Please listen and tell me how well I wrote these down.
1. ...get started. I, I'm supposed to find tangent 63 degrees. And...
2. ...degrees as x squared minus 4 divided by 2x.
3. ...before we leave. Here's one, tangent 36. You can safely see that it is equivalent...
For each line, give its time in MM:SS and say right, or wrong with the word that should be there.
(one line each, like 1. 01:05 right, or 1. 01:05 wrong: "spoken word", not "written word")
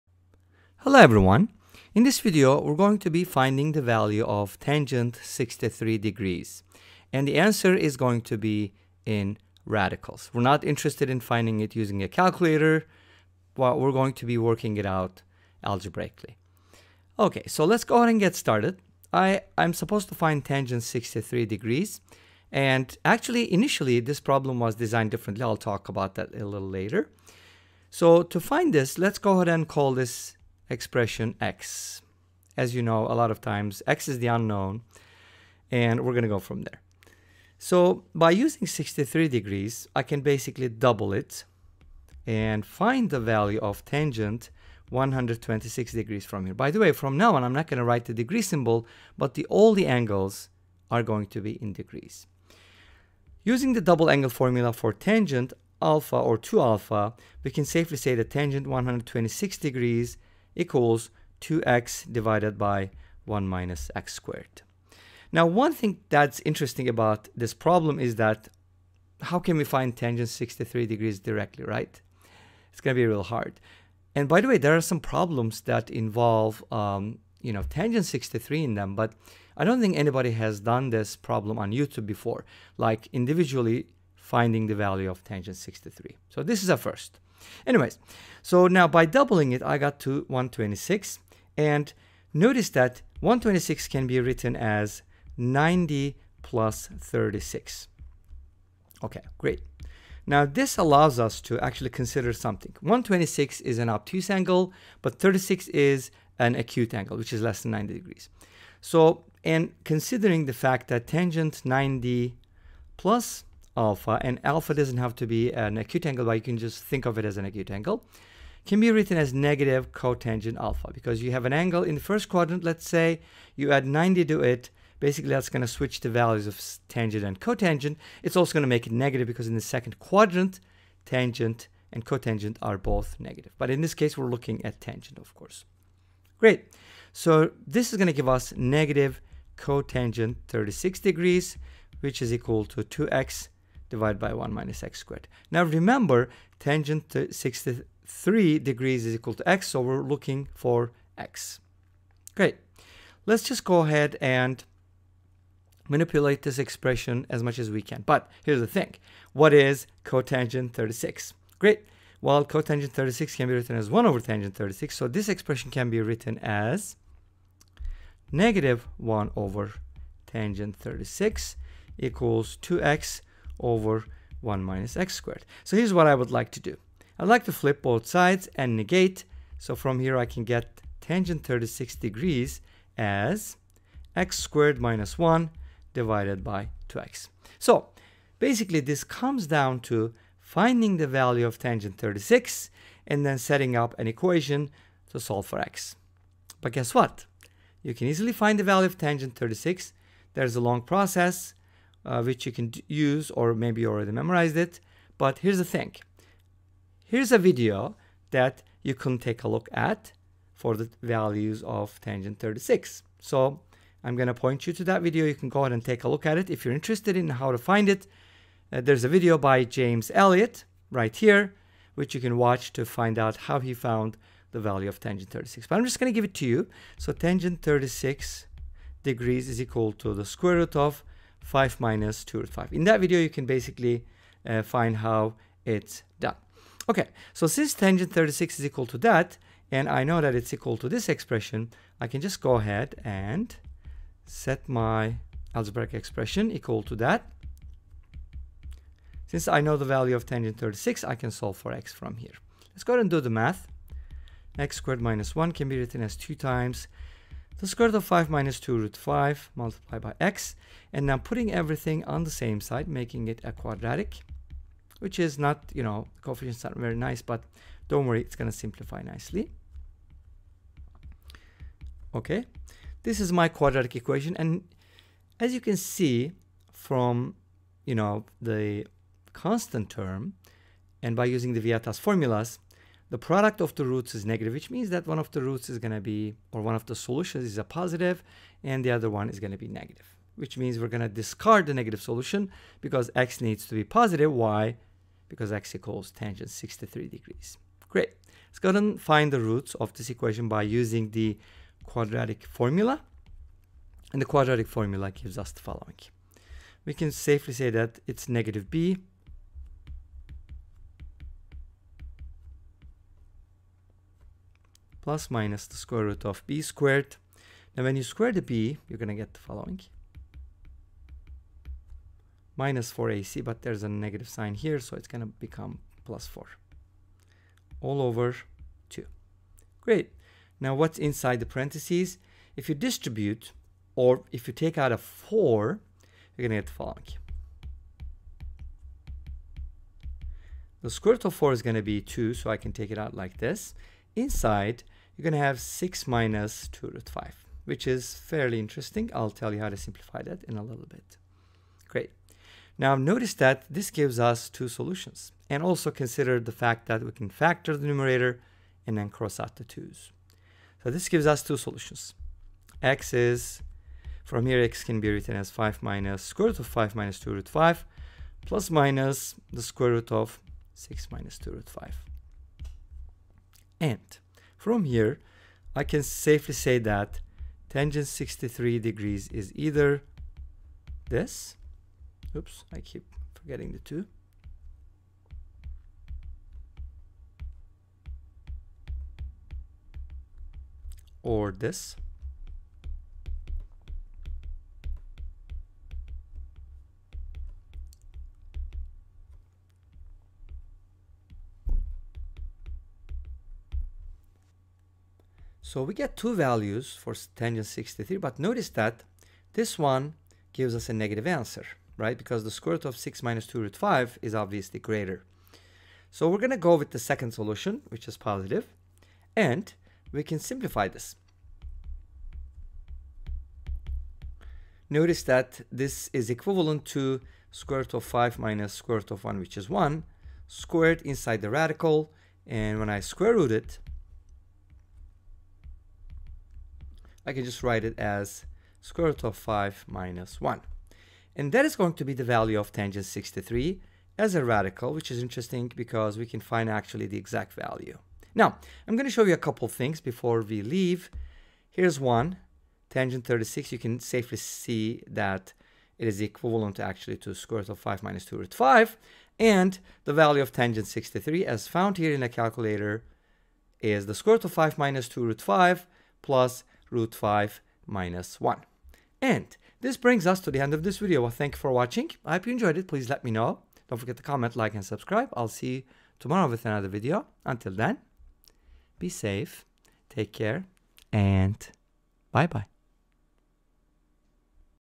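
1. 00:18 right
2. 03:01 wrong: "1", not "4"
3. 07:30 right.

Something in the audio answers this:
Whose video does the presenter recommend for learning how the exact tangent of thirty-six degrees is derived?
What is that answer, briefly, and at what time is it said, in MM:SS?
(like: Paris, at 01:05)
James Elliott, at 03:39.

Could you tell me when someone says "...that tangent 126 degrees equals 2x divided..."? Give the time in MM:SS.
00:58.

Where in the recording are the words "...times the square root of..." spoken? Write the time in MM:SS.
04:16.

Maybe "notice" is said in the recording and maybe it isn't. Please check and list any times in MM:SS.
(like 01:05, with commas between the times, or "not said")
01:32, 05:52, 06:48, 07:04.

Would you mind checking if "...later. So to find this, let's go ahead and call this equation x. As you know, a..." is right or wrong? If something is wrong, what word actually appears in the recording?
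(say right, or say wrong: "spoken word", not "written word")
wrong: "expression", not "equation".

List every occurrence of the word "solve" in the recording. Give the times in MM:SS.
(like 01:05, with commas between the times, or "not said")
03:15, 04:11.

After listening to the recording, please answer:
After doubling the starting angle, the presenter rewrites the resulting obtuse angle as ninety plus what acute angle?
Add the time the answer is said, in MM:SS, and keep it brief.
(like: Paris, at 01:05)
36, at 01:35.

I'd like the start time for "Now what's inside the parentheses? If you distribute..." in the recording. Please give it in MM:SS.
05:30.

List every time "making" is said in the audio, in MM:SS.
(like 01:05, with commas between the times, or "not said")
04:22.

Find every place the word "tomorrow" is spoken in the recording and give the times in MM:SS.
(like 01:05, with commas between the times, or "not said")
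07:56.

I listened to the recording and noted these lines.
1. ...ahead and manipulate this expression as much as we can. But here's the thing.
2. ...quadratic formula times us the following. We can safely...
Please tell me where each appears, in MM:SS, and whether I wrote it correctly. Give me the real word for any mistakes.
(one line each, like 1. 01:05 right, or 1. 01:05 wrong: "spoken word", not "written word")
1. 02:33 right
2. 05:04 wrong: "gives", not "times".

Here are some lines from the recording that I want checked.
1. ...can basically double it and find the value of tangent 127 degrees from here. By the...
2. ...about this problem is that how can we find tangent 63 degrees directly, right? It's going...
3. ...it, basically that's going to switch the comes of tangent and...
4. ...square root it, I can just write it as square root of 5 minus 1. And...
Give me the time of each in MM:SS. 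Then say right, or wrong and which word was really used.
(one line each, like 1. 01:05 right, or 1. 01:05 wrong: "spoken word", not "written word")
1. 00:40 wrong: "126", not "127"
2. 01:06 right
3. 02:04 wrong: "values", not "comes"
4. 07:12 right.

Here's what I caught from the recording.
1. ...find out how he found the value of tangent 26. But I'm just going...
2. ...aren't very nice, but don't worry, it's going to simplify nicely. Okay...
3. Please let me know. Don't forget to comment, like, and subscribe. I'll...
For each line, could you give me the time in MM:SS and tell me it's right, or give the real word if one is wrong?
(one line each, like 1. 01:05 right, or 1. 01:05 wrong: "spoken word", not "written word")
1. 03:42 wrong: "36", not "26"
2. 04:26 right
3. 07:52 right.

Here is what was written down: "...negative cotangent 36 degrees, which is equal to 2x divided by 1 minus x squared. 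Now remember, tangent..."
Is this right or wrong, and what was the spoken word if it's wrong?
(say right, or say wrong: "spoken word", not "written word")
right.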